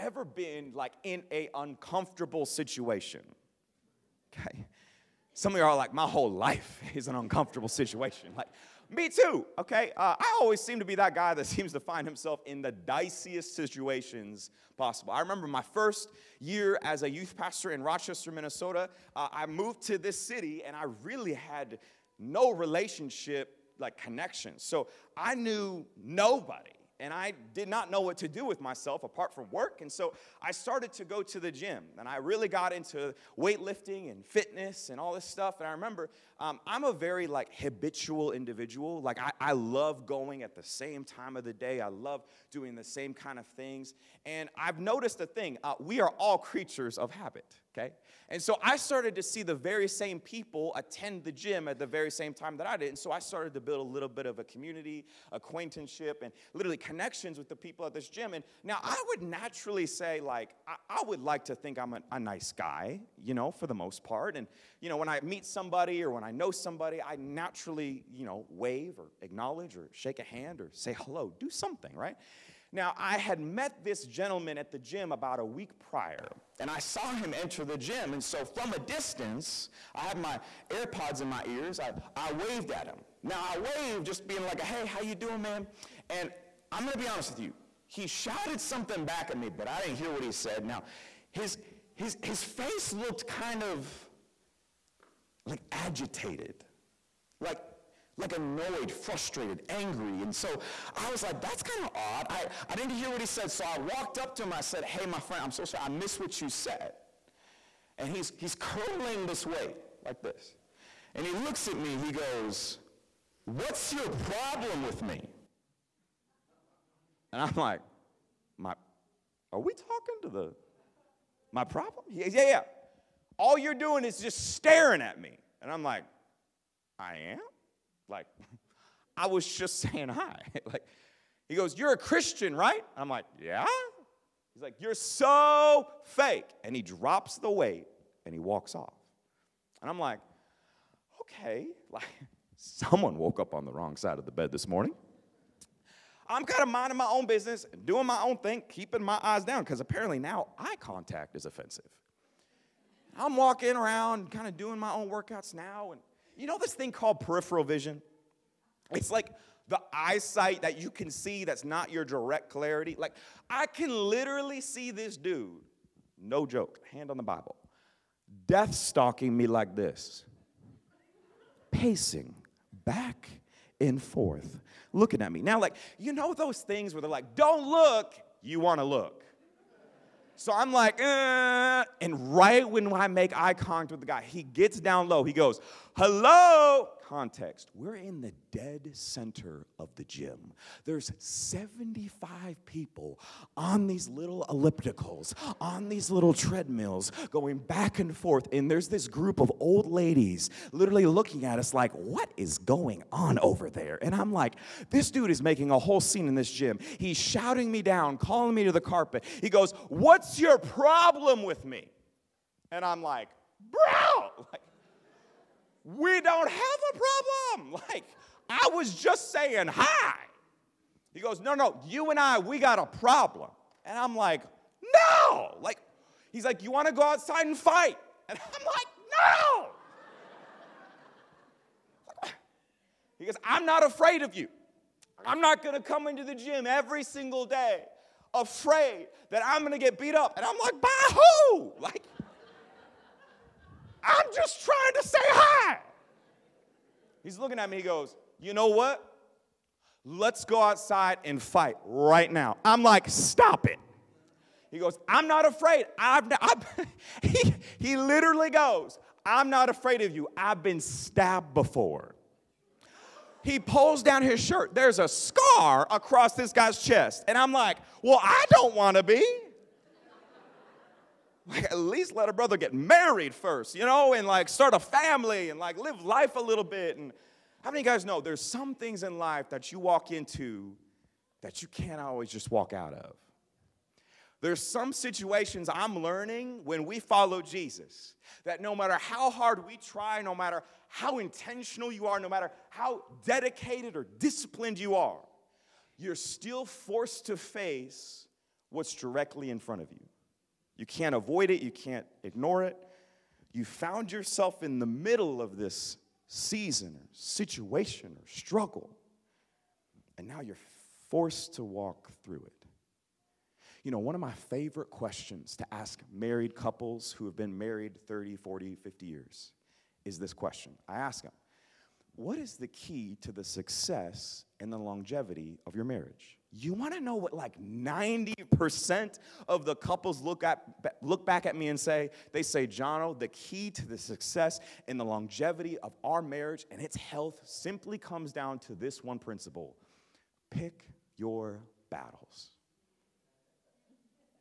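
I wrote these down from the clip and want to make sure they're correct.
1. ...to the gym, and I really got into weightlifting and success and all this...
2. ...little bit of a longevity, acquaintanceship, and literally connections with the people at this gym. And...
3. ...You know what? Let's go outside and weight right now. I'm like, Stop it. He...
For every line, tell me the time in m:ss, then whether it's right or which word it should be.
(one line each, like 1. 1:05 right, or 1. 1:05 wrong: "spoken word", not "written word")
1. 0:31 wrong: "fitness", not "success"
2. 0:53 wrong: "community", not "longevity"
3. 4:08 wrong: "fight", not "weight".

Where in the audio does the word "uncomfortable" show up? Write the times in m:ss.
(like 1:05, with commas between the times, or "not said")
0:01, 0:07.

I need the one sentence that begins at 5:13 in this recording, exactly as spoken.
You know, one of my favorite questions to ask married couples who have been married 30, 40, 50 years is this question.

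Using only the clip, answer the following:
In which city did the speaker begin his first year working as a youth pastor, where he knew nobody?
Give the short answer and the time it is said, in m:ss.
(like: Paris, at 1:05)
Rochester, Minnesota, at 0:17.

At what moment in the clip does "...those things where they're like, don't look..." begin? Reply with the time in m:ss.
2:56.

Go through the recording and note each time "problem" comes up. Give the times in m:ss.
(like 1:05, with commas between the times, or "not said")
1:54, 2:01, 3:30, 3:36, 3:42.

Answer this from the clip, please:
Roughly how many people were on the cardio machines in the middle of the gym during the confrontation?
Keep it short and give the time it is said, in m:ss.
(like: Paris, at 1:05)
75, at 3:11.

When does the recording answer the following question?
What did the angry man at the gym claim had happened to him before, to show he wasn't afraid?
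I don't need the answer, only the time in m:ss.
4:20.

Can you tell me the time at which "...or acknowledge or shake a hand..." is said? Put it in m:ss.
1:08.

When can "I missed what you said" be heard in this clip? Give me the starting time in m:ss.
1:45.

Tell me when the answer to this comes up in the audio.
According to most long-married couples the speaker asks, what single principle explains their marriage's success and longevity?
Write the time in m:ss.
5:40.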